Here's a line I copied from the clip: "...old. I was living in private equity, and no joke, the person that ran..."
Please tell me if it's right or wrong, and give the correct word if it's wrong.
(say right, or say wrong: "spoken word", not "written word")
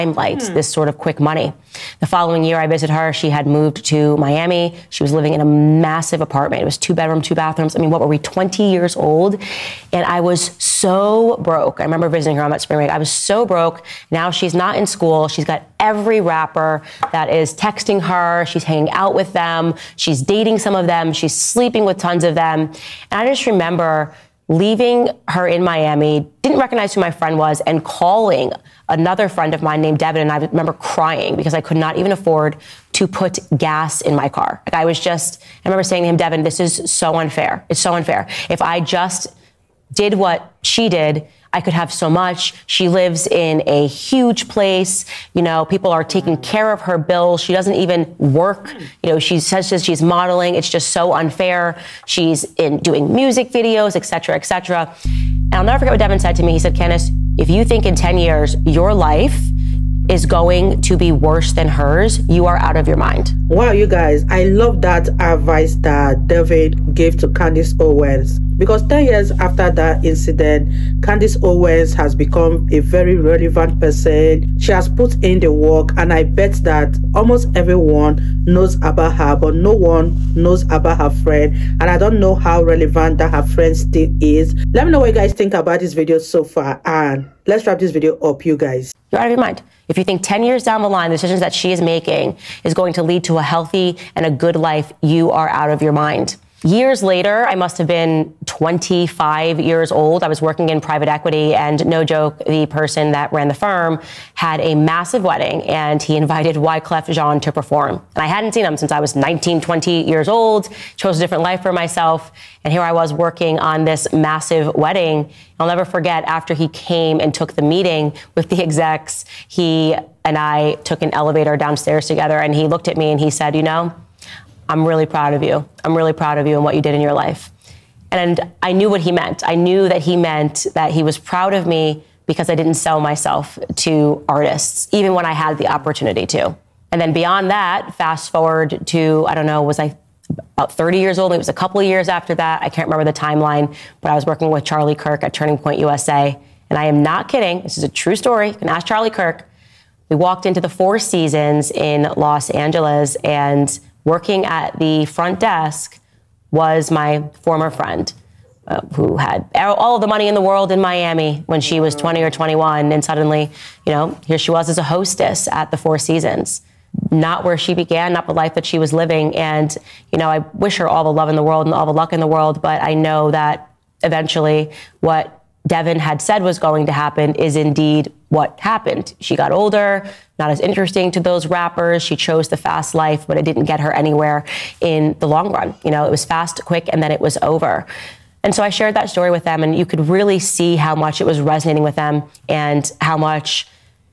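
wrong: "working", not "living".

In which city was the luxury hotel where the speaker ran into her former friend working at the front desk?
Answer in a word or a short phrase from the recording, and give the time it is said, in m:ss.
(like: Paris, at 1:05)
Los Angeles, at 2:32.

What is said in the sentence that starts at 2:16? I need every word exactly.
And then beyond that, fast forward to, I don't know, was I about 30 years old?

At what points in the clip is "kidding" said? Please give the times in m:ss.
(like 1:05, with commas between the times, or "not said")
2:27.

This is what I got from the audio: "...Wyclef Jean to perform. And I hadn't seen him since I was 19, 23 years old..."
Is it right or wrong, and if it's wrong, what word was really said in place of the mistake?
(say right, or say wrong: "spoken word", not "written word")
wrong: "20", not "23".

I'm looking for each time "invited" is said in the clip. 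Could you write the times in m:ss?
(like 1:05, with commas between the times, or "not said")
1:46.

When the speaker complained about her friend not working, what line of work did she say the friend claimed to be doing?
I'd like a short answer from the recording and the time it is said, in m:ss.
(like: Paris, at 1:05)
Modeling, at 0:50.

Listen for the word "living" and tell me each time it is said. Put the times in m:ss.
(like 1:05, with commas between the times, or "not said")
0:05, 2:48.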